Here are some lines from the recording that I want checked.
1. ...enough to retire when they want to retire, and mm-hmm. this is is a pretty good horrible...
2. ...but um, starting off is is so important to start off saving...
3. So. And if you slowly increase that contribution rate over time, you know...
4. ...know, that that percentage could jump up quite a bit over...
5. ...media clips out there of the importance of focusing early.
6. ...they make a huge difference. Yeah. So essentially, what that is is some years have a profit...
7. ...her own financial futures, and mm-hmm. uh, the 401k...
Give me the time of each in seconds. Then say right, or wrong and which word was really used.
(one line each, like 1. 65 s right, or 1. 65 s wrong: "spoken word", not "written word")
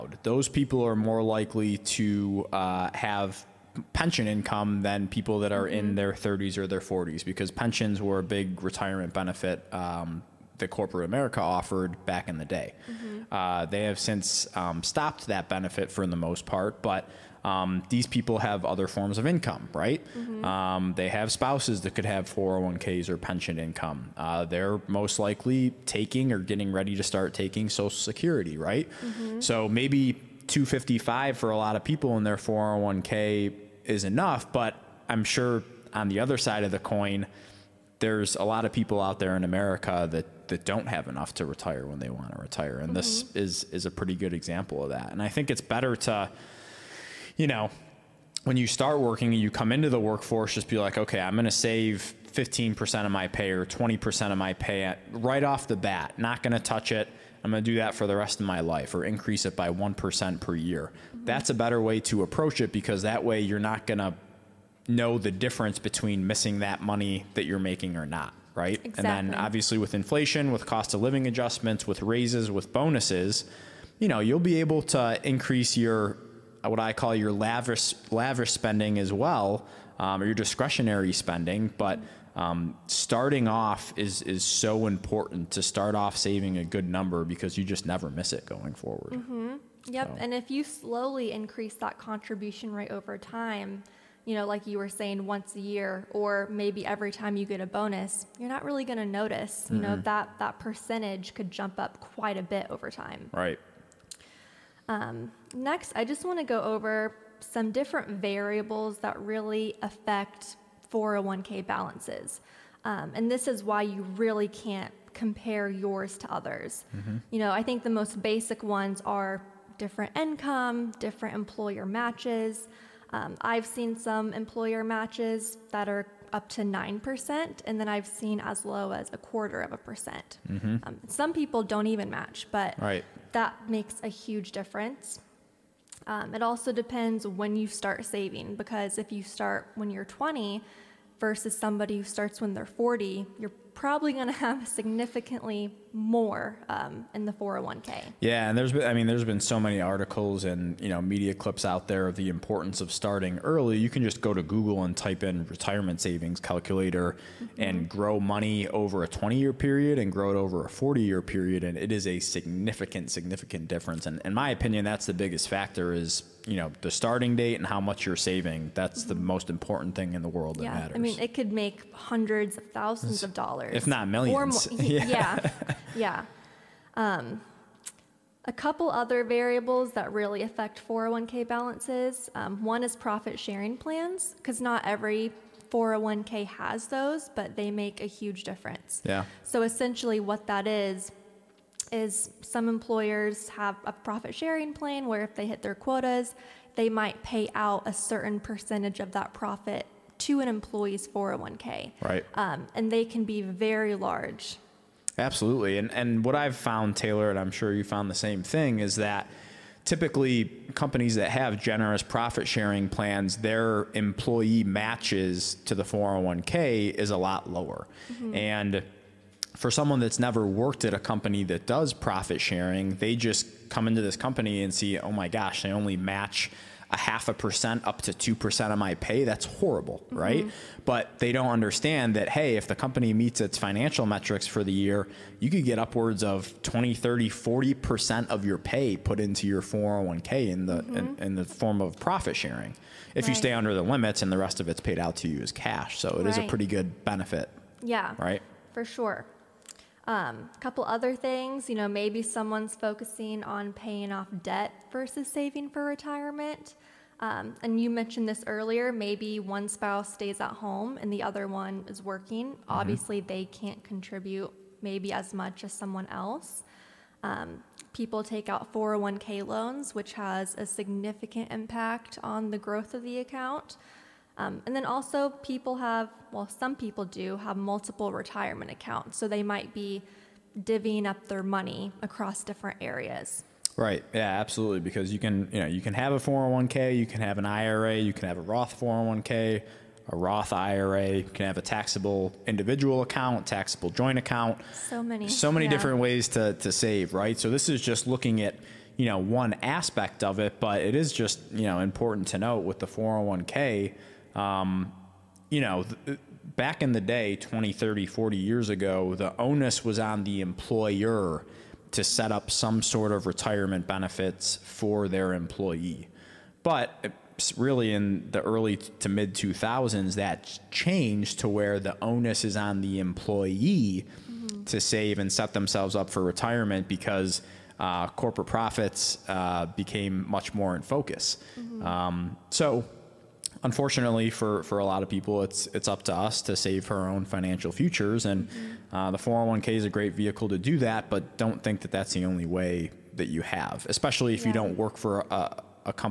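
1. 41 s wrong: "example", not "horrible"
2. 81 s right
3. 90 s right
4. 99 s right
5. 151 s wrong: "starting", not "focusing"
6. 187 s wrong: "employers", not "years"
7. 336 s right.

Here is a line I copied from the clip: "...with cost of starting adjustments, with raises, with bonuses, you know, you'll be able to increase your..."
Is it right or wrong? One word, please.
wrong.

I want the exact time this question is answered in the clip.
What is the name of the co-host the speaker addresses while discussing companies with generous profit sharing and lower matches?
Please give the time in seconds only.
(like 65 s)
206 s.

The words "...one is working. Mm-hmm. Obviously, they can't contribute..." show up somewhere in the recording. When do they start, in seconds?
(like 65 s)
261 s.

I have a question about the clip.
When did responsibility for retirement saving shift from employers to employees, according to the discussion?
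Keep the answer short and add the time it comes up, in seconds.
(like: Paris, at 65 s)
early to mid 2000s, at 318 s.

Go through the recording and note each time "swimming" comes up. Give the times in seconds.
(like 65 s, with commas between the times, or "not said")
not said.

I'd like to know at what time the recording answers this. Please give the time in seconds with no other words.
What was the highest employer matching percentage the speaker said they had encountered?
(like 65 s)
126 s.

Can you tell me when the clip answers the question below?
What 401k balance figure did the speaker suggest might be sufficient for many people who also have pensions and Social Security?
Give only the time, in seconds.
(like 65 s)
30 s.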